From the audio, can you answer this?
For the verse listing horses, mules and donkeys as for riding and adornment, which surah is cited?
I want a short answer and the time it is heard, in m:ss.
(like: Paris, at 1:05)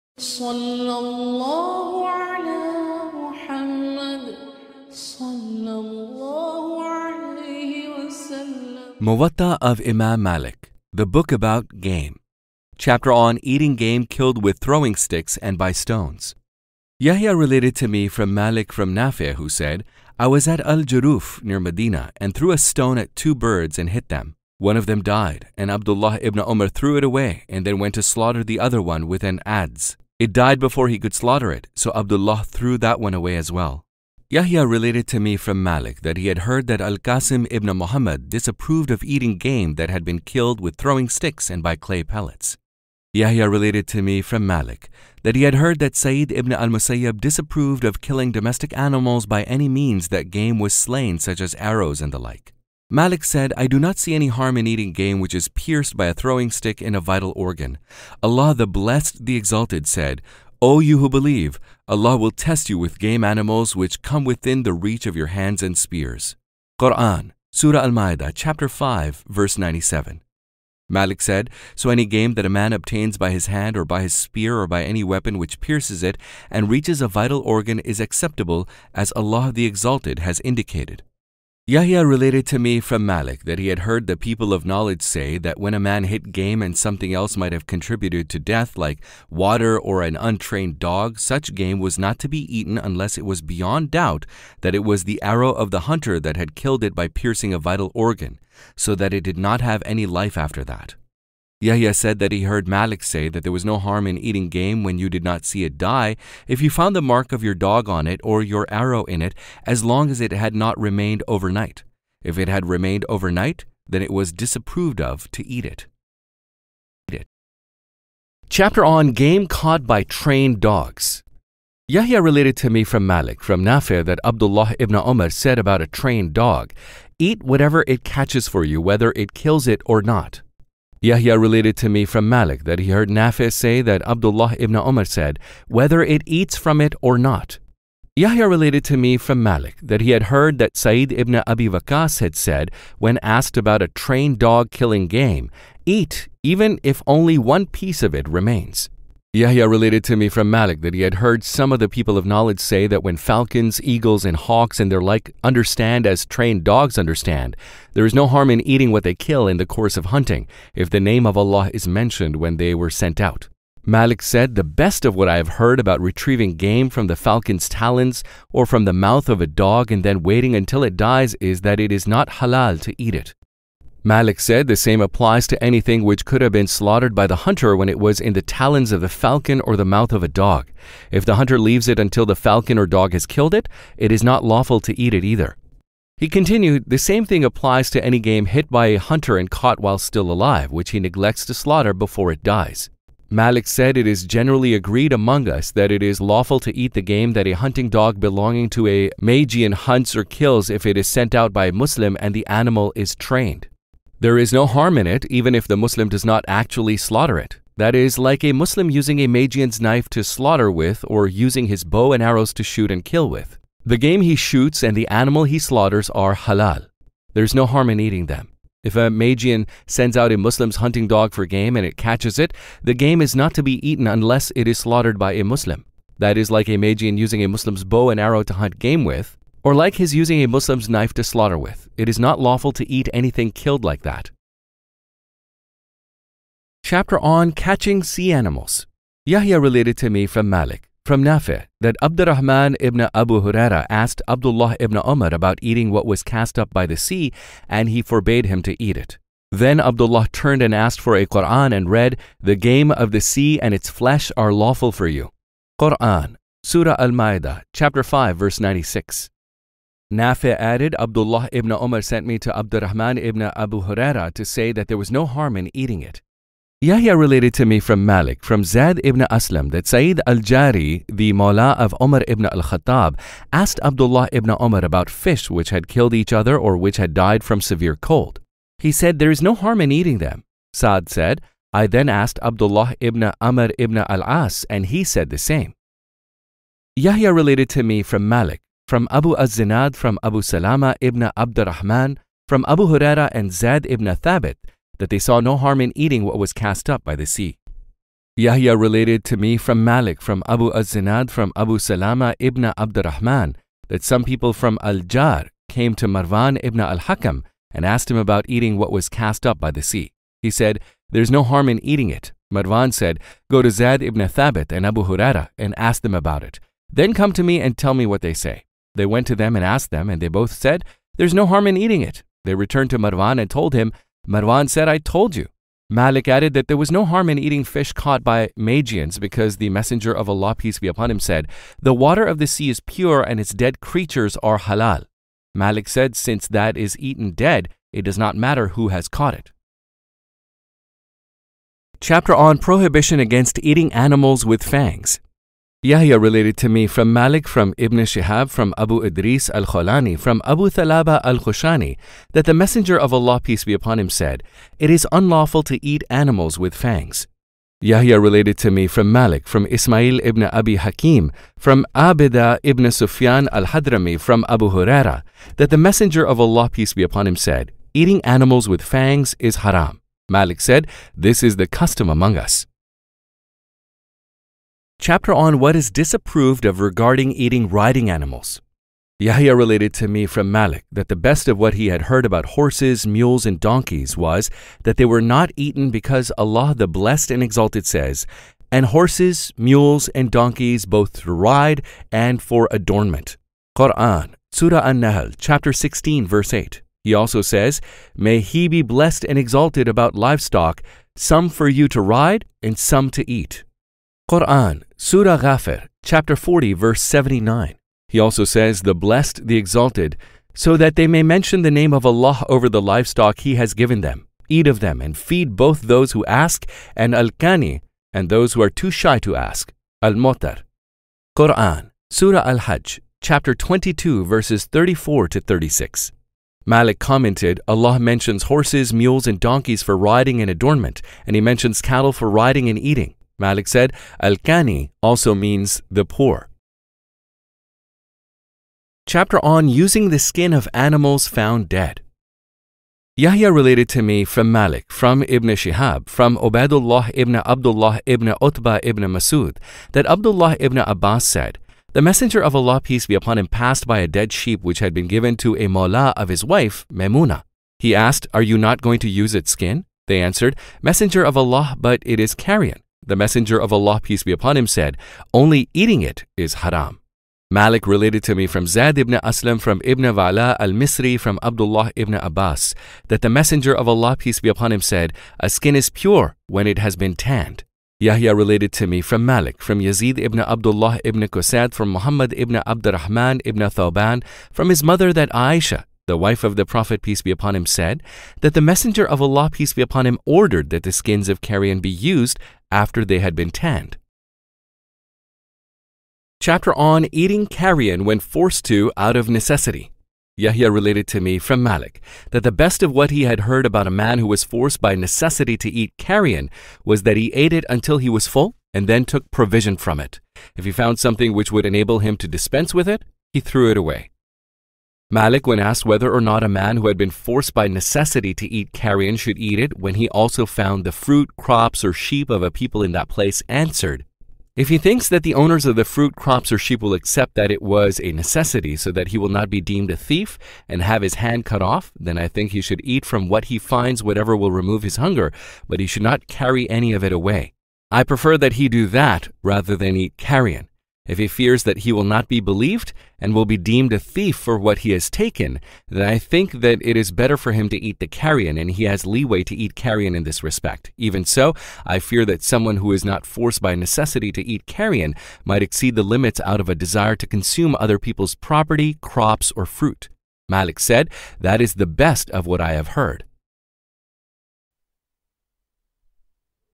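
Surah An-Nahl, at 6:34.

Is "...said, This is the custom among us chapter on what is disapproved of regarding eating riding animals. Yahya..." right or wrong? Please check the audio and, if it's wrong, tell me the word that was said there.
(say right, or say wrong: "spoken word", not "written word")
right.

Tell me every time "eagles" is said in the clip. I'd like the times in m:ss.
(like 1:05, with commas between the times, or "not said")
2:33.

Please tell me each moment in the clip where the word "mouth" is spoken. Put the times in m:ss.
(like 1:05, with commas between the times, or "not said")
2:48, 2:59.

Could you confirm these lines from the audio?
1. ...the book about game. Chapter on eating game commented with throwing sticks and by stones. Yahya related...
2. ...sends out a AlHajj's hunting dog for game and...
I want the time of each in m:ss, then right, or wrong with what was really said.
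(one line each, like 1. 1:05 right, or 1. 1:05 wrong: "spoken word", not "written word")
1. 0:10 wrong: "killed", not "commented"
2. 3:39 wrong: "Muslim", not "AlHajj".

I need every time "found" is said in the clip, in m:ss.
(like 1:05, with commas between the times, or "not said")
1:46, 7:21, 8:30, 8:40.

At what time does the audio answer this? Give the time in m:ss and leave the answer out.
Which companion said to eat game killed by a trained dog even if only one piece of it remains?
2:20.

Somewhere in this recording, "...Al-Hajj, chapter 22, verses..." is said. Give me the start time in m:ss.
7:02.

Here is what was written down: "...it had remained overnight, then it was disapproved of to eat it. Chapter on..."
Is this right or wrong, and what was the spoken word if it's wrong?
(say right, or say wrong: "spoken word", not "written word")
right.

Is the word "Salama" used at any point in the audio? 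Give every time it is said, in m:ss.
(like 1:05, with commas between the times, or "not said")
4:50, 5:01.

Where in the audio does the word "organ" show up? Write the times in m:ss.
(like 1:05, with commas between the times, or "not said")
0:57, 1:17, 1:37.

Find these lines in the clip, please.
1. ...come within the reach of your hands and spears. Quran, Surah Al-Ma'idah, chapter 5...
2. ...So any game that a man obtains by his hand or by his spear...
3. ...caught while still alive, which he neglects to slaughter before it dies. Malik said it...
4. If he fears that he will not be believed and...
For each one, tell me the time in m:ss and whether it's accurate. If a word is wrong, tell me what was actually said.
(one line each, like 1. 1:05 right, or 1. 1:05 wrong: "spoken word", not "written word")
1. 1:04 right
2. 1:11 right
3. 3:09 right
4. 9:01 right.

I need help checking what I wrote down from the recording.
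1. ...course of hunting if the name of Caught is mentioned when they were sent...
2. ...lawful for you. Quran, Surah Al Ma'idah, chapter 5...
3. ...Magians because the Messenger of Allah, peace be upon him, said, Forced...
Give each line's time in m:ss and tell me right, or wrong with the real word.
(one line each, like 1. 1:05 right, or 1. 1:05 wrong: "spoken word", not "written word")
1. 2:39 wrong: "Allah", not "Caught"
2. 4:14 right
3. 5:28 wrong: "The", not "Forced".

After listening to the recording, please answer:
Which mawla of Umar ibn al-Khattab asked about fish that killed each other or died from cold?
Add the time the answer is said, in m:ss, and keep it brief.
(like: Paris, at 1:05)
Sa'id al-Jari, at 4:29.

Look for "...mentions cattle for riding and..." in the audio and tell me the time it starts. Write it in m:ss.
7:11.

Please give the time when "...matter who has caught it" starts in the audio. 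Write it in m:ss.
5:38.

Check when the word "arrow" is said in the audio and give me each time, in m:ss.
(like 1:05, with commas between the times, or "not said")
0:51, 1:35, 1:48, 3:32, 3:48.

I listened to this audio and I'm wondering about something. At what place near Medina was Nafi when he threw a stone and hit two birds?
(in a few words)
Al-Juruf.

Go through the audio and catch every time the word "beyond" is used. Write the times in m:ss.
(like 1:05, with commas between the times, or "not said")
1:33.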